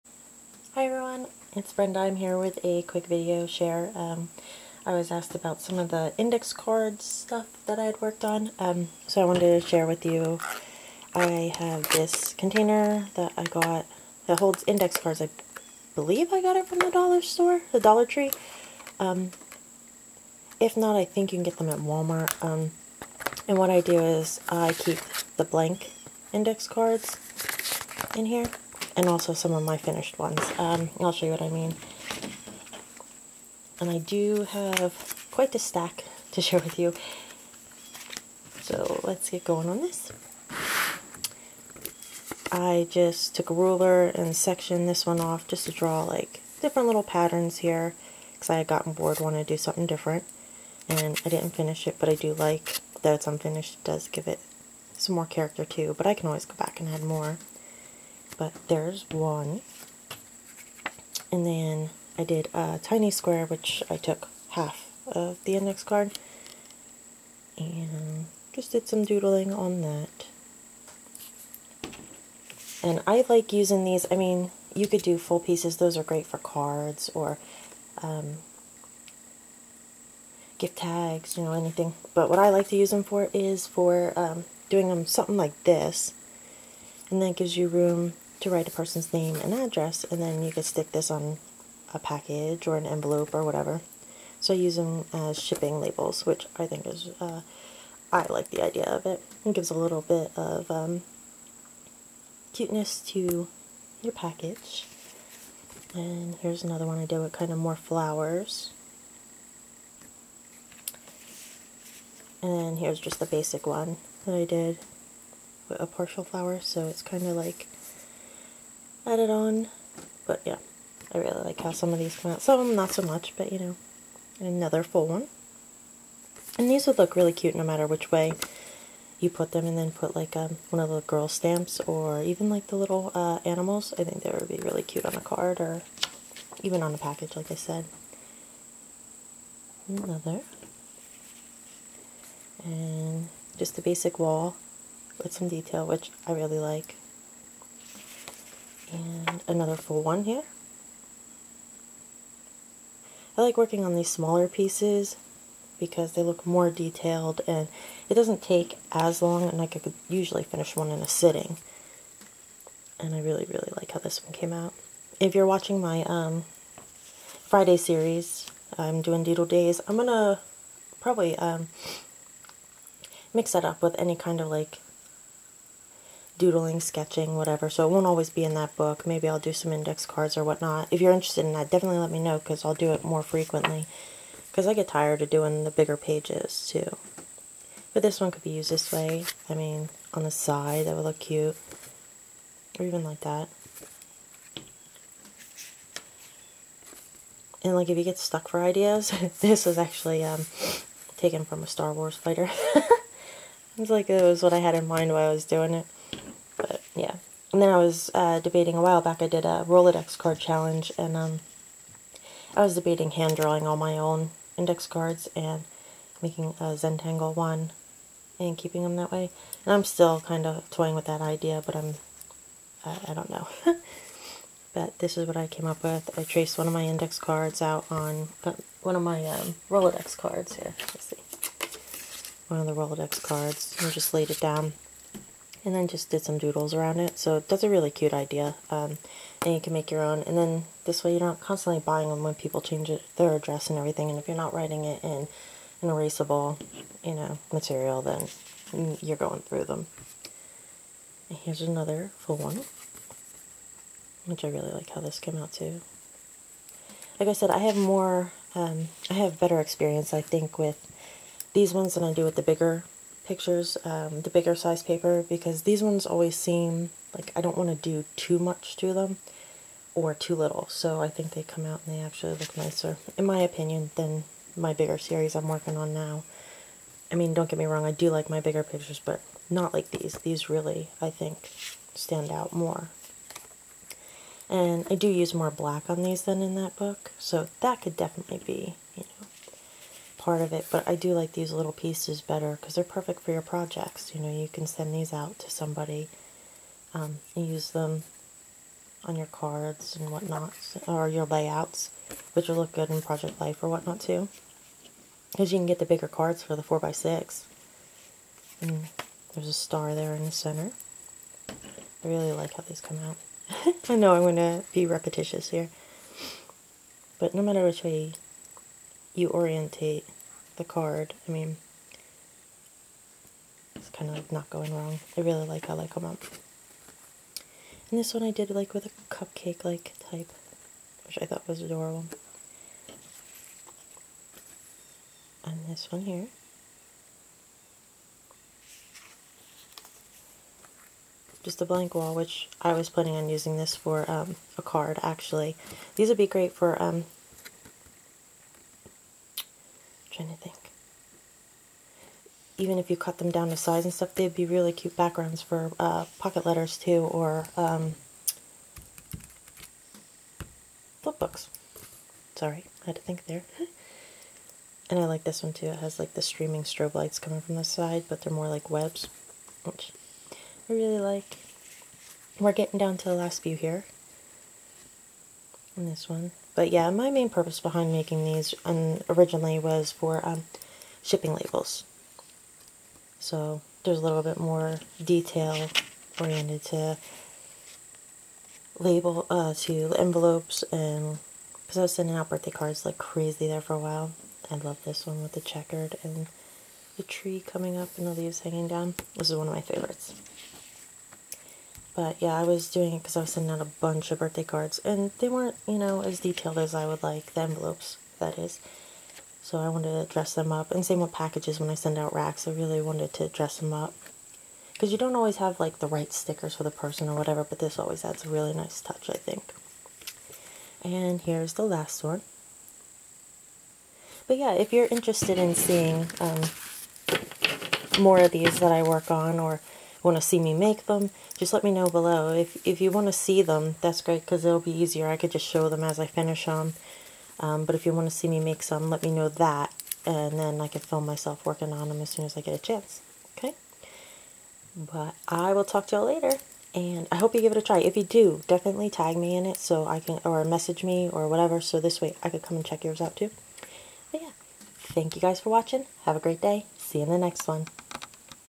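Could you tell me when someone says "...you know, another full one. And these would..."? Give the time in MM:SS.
02:03.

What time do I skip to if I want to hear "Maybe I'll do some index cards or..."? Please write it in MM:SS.
02:59.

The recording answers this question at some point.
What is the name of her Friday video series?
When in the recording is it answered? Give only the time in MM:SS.
02:49.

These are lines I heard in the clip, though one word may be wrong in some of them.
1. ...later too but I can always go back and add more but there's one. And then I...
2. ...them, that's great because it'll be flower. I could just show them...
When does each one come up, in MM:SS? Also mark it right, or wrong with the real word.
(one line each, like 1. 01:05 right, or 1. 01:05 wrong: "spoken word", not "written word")
1. 00:55 wrong: "character", not "later"
2. 07:13 wrong: "easier", not "flower".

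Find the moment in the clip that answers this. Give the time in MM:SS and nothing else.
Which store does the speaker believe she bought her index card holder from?
00:17.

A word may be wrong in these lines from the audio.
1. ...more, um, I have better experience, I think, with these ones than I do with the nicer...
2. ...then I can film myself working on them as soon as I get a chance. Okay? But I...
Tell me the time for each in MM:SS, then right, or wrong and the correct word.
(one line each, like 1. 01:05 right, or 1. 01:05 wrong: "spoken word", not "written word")
1. 04:17 wrong: "bigger", not "nicer"
2. 07:20 right.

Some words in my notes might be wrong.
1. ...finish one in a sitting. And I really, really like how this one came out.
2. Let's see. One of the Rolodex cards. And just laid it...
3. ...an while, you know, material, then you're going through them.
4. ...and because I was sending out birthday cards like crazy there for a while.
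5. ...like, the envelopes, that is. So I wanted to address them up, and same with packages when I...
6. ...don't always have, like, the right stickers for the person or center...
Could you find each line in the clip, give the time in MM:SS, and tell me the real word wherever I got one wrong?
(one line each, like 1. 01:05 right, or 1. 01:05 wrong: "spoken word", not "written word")
1. 02:40 right
2. 03:50 right
3. 04:05 wrong: "erasable", not "while"
4. 06:30 right
5. 06:47 wrong: "dress", not "address"
6. 06:54 wrong: "whatever", not "center".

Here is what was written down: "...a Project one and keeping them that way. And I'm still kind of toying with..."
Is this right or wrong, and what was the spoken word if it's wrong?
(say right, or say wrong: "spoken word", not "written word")
wrong: "Zentangle", not "Project".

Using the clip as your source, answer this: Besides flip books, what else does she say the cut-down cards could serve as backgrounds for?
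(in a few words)
Pocket letters.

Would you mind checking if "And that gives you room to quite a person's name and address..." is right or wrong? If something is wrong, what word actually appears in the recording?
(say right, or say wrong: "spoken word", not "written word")
wrong: "write", not "quite".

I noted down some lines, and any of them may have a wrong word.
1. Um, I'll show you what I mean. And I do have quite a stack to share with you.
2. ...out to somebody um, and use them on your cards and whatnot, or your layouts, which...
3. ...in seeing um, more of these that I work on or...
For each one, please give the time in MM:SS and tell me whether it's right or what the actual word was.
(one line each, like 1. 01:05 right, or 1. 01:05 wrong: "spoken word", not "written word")
1. 00:30 right
2. 04:55 right
3. 07:05 right.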